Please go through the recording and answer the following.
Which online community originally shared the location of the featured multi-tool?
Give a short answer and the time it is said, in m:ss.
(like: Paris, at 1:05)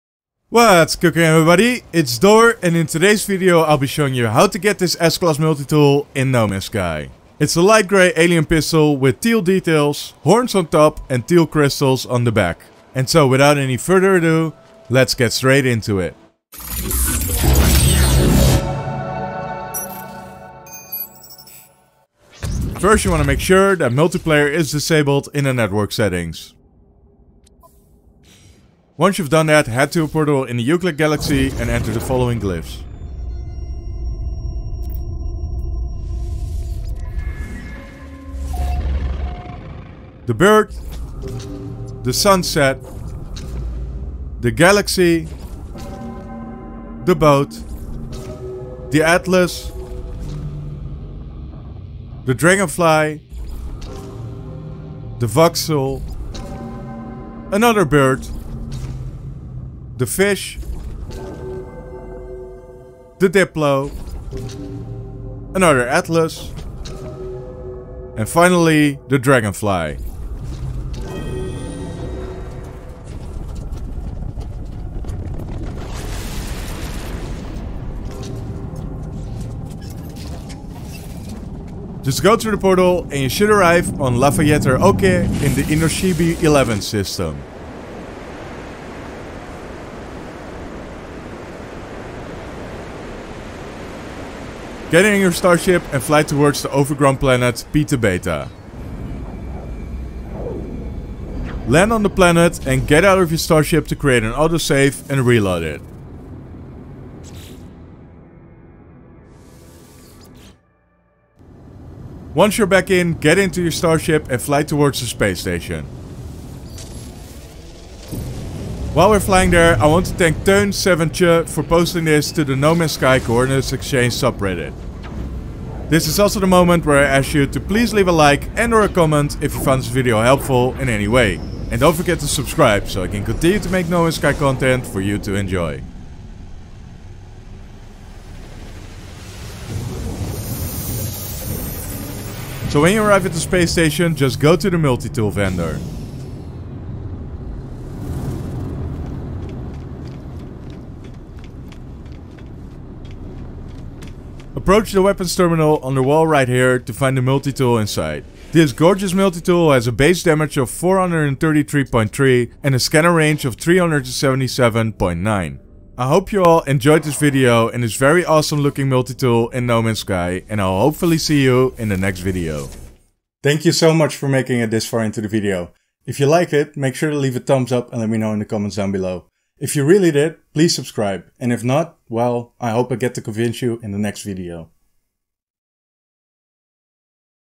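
No Man's Sky Coordinates Exchange subreddit, at 2:02.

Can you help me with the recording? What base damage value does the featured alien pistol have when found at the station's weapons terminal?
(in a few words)
433.3.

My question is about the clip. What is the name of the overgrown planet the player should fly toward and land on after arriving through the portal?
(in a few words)
Beta Beta.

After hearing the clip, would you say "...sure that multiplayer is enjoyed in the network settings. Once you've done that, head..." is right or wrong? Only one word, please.
wrong.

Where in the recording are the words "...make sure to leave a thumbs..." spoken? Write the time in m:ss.
2:56.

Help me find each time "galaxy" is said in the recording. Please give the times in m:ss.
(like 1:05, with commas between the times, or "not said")
0:30, 0:44.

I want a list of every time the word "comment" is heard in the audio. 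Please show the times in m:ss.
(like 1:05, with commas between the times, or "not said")
2:08, 2:58.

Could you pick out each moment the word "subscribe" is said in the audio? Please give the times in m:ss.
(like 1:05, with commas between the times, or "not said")
2:12, 3:00.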